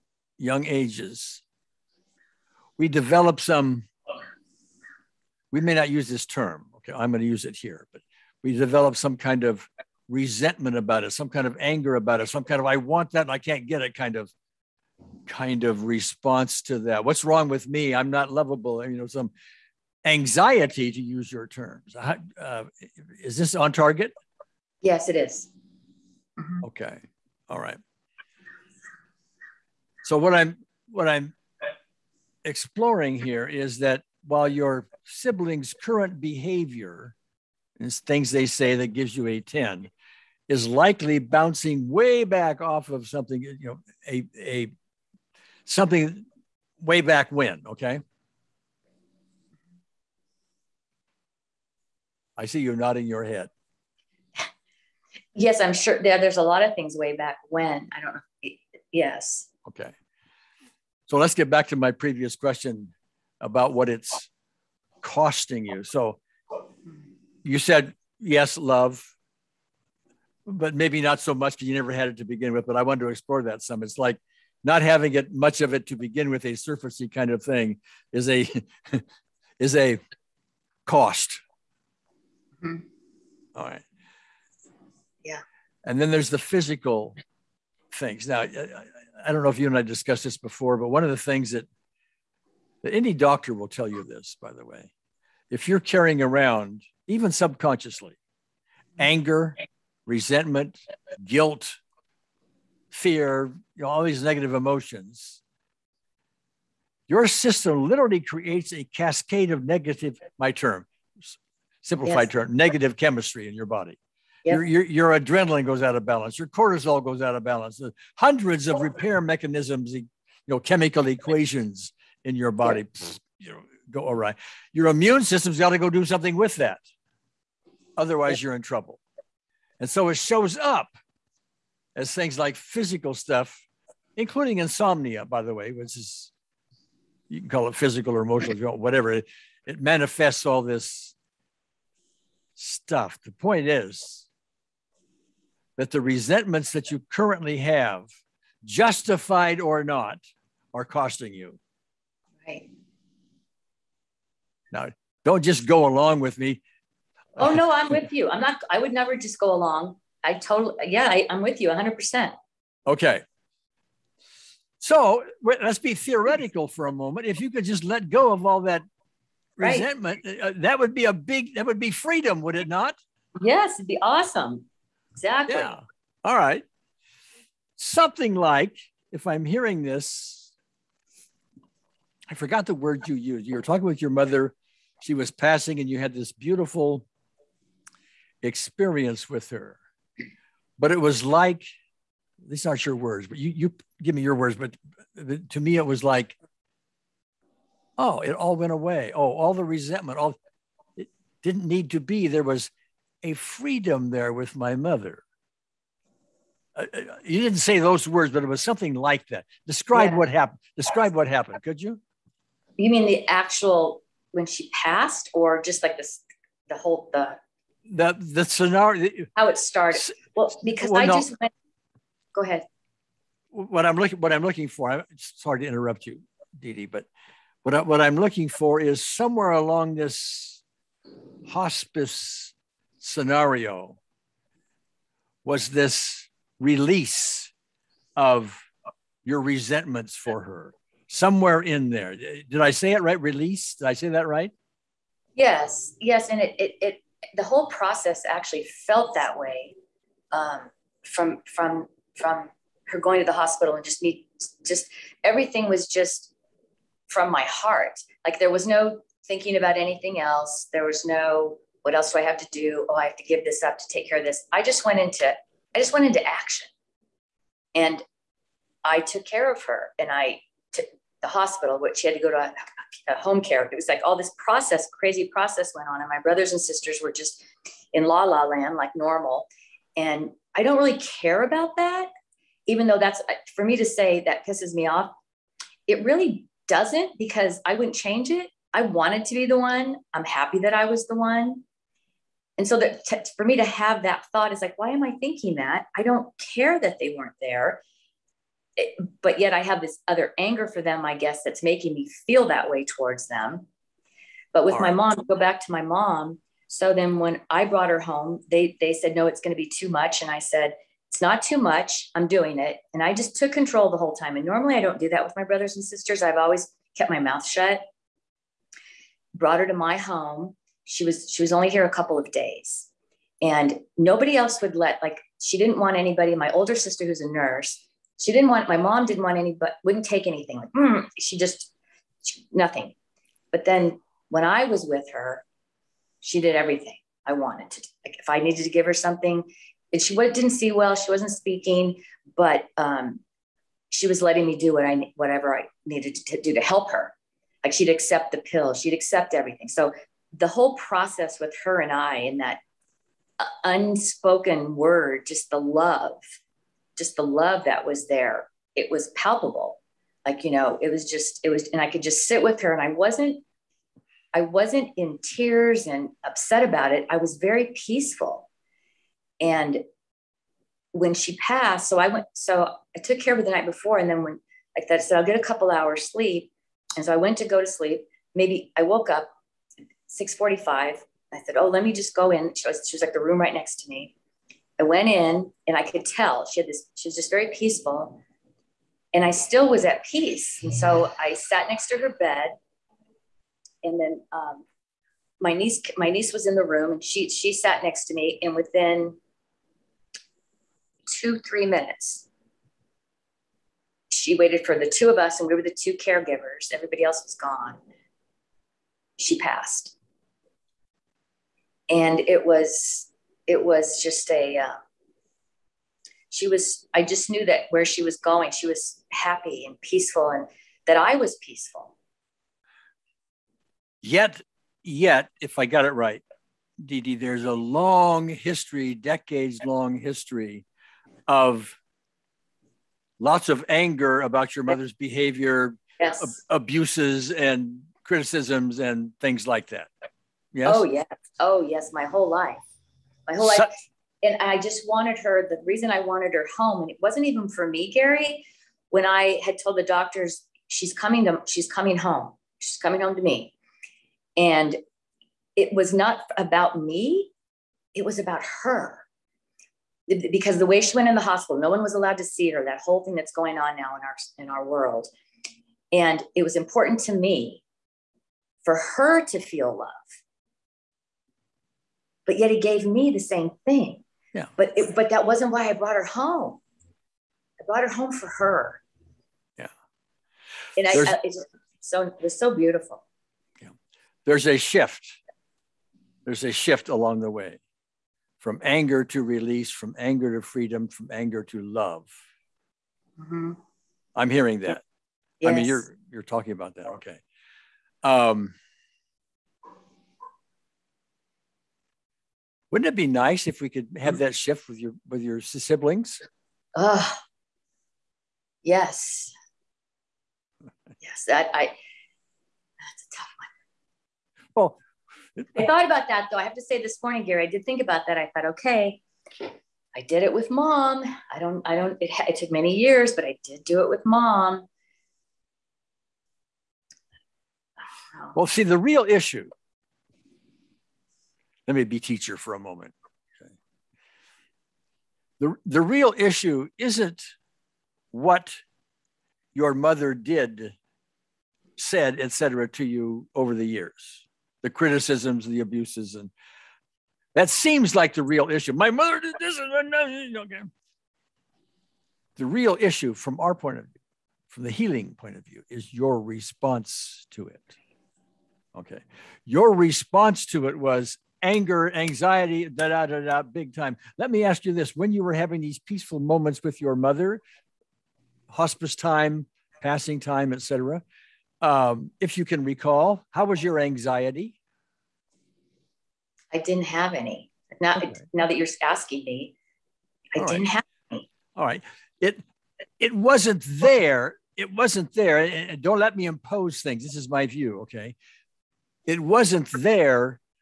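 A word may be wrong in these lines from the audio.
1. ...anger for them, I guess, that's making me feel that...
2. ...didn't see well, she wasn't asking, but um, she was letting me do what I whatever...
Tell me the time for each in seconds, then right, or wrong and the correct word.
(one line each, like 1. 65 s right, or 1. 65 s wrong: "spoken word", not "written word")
1. 300 s right
2. 340 s wrong: "speaking", not "asking".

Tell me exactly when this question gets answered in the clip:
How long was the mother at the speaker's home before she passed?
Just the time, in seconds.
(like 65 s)
321 s.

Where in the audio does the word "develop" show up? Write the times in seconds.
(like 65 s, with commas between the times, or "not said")
2 s, 8 s.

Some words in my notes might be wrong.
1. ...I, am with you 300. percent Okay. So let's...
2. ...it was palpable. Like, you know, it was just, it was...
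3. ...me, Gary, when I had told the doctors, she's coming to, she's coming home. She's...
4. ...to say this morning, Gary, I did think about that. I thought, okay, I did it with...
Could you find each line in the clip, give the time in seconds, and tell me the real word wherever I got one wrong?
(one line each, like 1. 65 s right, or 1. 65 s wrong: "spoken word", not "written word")
1. 161 s wrong: "100", not "300"
2. 358 s right
3. 447 s right
4. 516 s right.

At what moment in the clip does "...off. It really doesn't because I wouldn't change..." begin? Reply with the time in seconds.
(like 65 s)
284 s.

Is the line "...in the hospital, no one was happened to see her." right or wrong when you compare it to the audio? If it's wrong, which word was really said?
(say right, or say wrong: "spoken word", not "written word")
wrong: "allowed", not "happened".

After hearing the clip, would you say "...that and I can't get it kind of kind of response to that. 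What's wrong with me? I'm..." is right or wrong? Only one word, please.
right.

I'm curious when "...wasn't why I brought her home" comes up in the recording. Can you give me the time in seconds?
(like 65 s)
475 s.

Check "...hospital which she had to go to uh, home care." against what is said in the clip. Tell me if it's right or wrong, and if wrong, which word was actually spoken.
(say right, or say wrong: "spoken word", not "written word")
right.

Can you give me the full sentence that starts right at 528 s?
Well, see, the real issue let me be teacher for a moment.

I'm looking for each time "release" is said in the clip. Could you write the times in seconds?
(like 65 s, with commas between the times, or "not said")
236 s, 243 s, 489 s.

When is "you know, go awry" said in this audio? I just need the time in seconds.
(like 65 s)
123 s.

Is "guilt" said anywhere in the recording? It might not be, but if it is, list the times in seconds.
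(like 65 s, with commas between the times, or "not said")
101 s.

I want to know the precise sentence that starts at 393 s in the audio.
And then um, my niece, my niece was in the room and she she sat next to me.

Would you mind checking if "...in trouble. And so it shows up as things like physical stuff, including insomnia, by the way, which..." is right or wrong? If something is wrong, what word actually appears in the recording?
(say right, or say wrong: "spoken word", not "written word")
right.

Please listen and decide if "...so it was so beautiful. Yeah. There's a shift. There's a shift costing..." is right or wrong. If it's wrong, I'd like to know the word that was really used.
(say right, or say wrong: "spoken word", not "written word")
wrong: "along", not "costing".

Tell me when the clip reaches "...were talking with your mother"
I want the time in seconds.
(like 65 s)
183 s.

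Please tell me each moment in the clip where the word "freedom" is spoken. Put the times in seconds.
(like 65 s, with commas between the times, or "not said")
171 s, 203 s, 490 s.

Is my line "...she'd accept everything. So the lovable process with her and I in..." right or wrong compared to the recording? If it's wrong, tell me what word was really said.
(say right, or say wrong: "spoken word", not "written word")
wrong: "whole", not "lovable".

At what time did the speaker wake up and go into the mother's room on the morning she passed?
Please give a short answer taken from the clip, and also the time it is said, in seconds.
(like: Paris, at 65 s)
6:45, at 380 s.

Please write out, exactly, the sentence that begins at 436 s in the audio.
ab- abuses and criticisms and things like that yes oh yes oh yes my whole life my whole life.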